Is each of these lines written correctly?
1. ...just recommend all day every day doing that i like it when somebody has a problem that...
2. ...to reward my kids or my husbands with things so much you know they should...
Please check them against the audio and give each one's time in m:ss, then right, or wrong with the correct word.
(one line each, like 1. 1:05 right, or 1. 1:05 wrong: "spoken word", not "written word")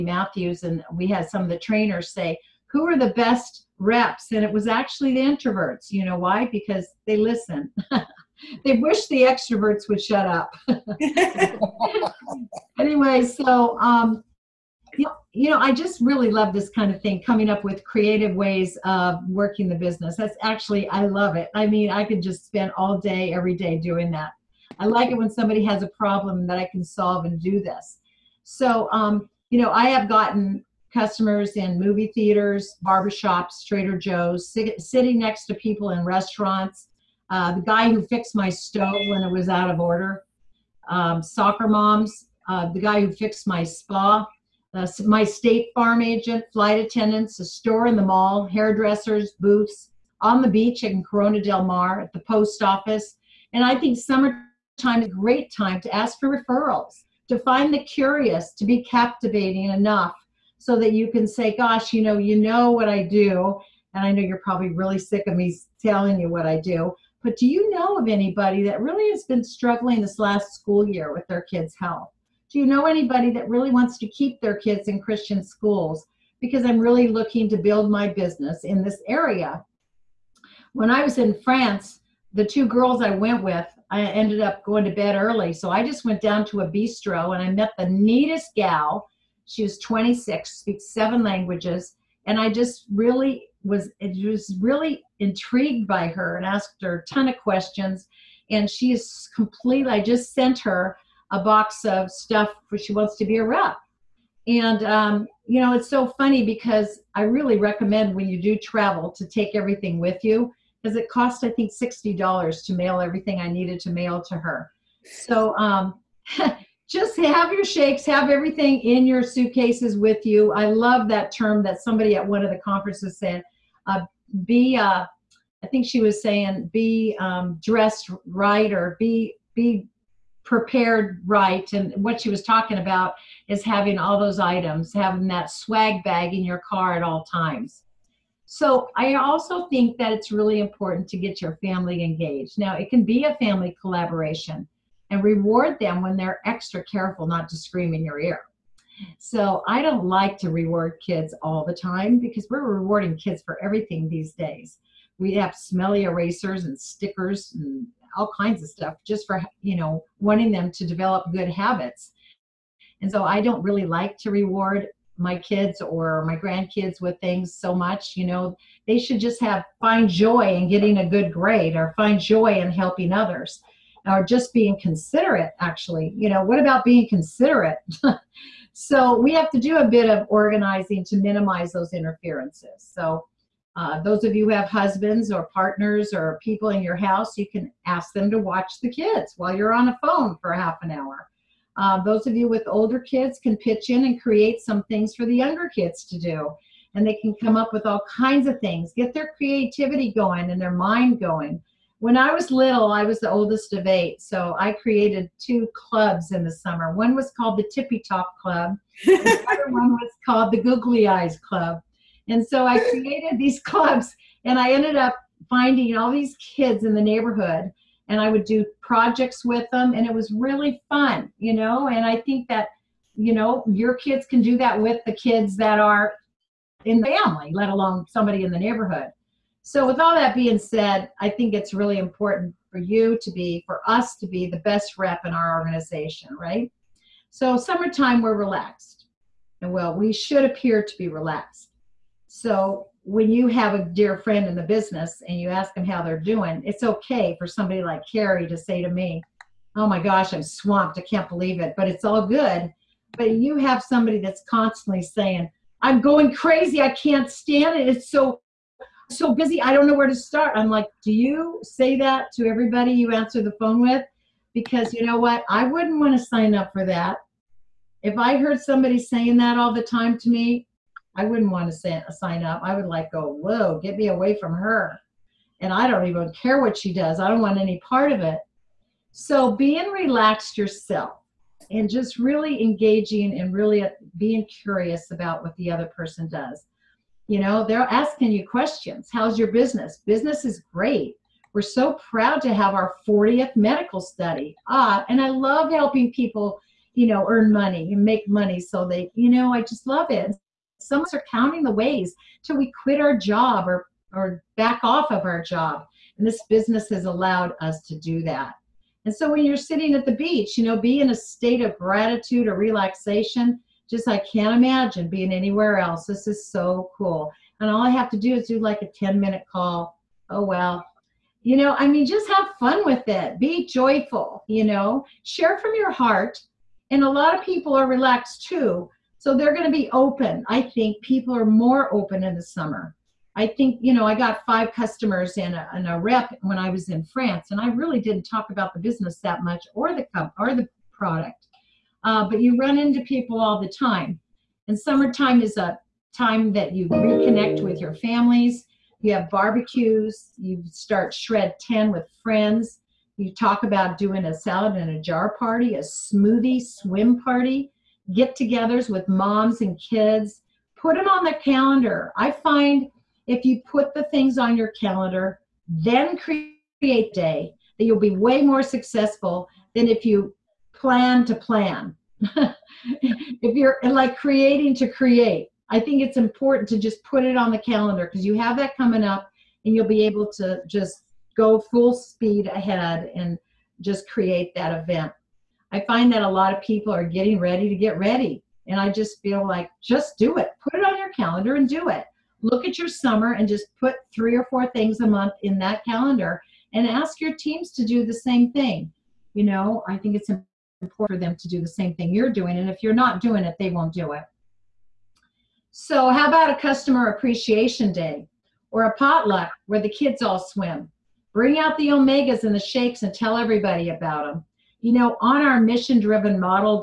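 1. 0:22 wrong: "spend", not "recommend"
2. 2:44 wrong: "grandkids", not "husbands".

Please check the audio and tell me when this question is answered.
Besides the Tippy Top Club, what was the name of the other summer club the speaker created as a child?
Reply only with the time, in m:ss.
3:30.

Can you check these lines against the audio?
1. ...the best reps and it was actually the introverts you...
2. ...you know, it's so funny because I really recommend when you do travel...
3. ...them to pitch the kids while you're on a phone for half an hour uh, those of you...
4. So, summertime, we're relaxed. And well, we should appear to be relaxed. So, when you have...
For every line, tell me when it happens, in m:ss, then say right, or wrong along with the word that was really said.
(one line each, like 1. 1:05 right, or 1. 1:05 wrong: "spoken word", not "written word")
1. 0:02 right
2. 1:45 right
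3. 3:08 wrong: "watch", not "pitch"
4. 3:57 right.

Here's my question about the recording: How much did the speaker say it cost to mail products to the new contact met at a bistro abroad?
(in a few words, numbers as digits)
$60.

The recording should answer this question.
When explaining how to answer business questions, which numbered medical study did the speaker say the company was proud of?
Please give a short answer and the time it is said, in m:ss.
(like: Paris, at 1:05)
40th, at 4:53.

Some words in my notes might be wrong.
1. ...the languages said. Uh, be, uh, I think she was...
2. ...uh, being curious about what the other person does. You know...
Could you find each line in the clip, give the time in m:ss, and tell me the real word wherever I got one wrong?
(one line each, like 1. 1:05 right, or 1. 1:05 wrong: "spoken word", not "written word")
1. 2:02 wrong: "conferences", not "languages"
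2. 4:43 right.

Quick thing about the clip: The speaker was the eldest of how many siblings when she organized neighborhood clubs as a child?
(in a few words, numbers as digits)
8.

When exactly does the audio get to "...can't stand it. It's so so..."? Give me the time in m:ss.
4:16.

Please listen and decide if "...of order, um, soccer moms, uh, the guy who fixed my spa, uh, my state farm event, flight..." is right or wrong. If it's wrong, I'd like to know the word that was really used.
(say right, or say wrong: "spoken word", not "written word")
wrong: "agent", not "event".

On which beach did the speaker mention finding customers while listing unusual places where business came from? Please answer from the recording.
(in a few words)
Corona del Mar.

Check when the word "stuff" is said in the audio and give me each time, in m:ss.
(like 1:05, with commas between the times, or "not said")
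1:42, 2:38.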